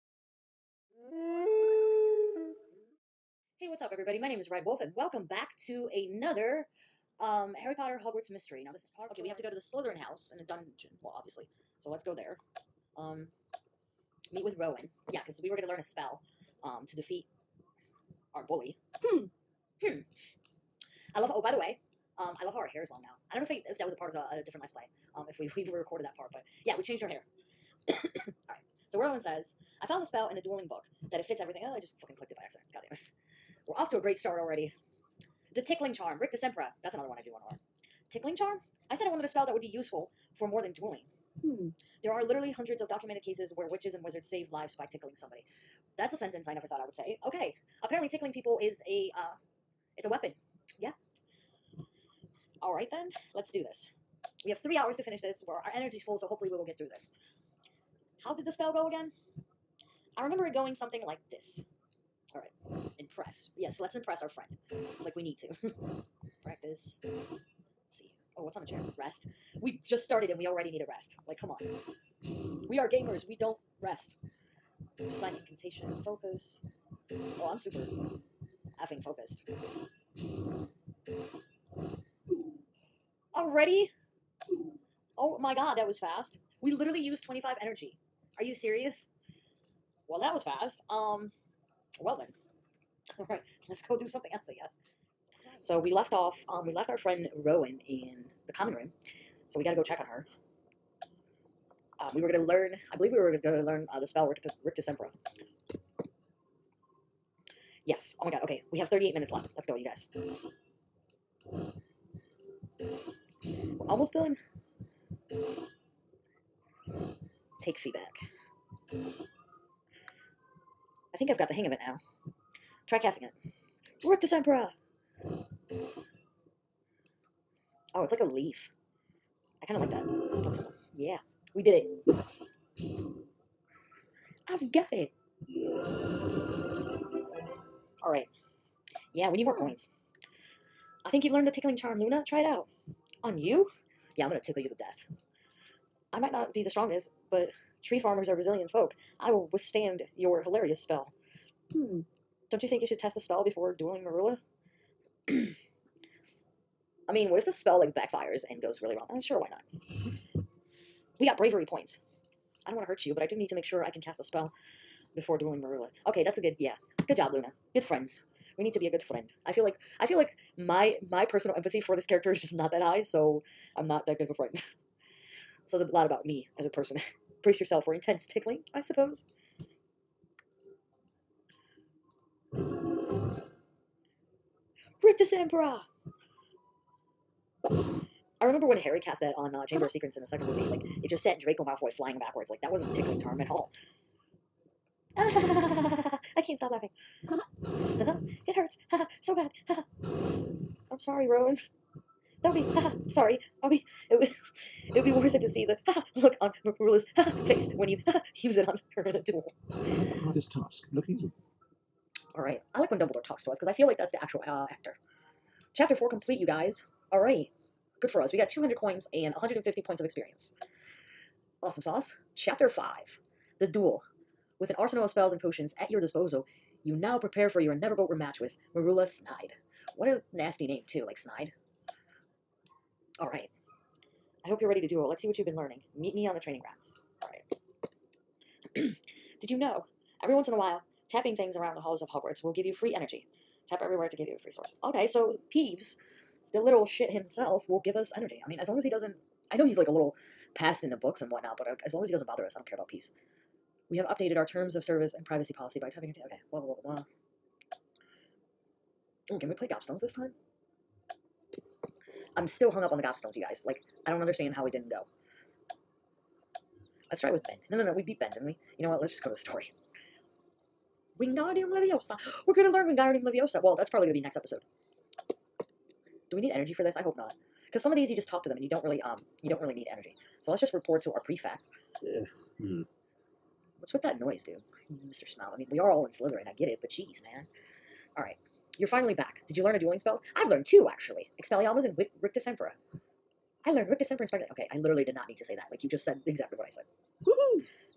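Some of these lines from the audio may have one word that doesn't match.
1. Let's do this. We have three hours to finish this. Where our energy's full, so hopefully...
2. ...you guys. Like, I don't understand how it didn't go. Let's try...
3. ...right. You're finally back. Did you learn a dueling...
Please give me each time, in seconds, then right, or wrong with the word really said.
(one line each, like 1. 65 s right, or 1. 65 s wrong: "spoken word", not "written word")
1. 53 s right
2. 263 s right
3. 288 s right.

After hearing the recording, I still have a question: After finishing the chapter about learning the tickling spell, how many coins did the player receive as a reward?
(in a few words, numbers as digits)
200.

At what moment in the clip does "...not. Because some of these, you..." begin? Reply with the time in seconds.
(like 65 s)
277 s.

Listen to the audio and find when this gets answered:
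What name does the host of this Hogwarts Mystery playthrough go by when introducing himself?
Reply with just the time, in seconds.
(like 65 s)
4 s.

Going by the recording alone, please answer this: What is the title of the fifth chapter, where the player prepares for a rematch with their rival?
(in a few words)
The Duel.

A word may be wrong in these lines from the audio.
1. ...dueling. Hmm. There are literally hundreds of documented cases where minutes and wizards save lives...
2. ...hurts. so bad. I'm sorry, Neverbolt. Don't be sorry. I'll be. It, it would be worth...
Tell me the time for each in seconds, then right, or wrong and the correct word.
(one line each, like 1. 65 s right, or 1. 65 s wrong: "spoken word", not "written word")
1. 40 s wrong: "witches", not "minutes"
2. 198 s wrong: "Rowan", not "Neverbolt".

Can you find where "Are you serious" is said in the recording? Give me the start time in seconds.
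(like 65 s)
88 s.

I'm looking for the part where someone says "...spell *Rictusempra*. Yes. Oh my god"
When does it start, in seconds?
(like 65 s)
104 s.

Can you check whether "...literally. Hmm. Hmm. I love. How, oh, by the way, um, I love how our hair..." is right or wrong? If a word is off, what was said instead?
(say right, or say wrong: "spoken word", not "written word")
wrong: "bully", not "literally".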